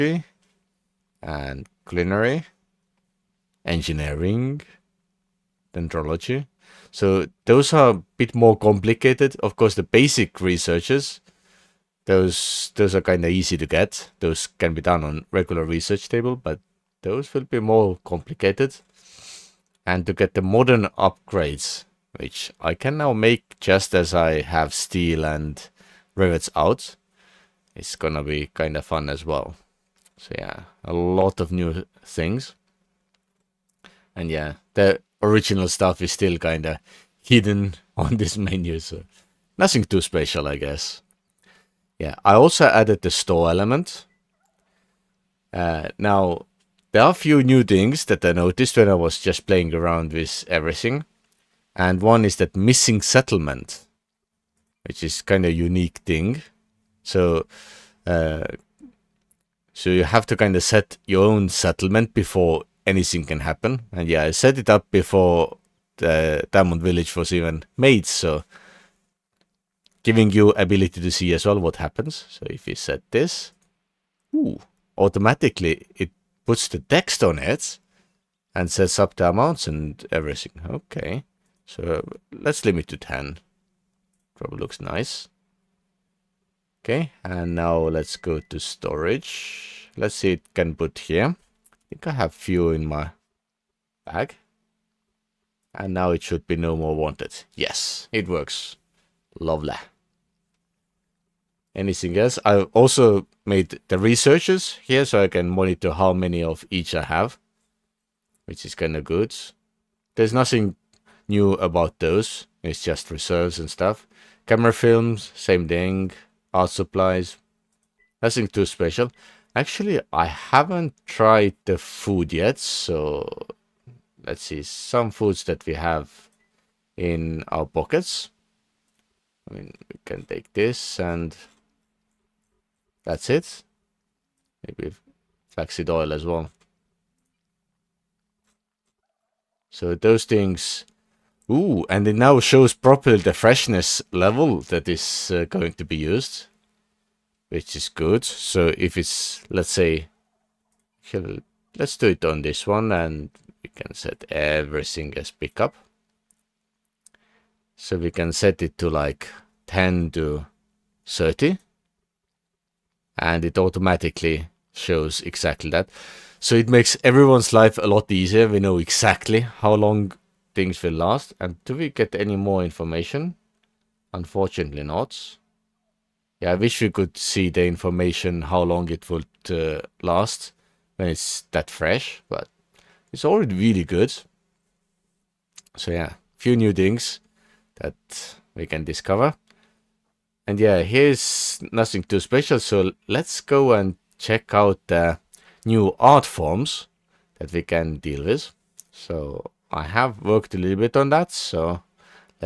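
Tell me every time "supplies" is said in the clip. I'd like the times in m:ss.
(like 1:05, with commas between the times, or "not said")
1:56.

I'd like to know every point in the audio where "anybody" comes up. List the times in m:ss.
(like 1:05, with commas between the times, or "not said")
not said.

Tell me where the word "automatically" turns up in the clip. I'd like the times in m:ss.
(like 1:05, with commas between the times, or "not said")
1:14, 2:43.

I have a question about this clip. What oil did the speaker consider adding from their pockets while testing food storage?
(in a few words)
Flaxseed oil.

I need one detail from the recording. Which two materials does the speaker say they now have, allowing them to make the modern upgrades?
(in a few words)
Steel and rivets.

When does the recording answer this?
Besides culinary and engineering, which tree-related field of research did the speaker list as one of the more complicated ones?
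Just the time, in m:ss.
0:05.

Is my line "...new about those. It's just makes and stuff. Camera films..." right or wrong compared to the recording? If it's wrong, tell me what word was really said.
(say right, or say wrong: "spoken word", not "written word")
wrong: "reserves", not "makes".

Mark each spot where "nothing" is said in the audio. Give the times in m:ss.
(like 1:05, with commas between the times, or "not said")
0:39, 1:50, 1:58, 3:11.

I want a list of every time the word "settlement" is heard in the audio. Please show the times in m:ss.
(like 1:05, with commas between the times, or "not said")
0:53, 1:01.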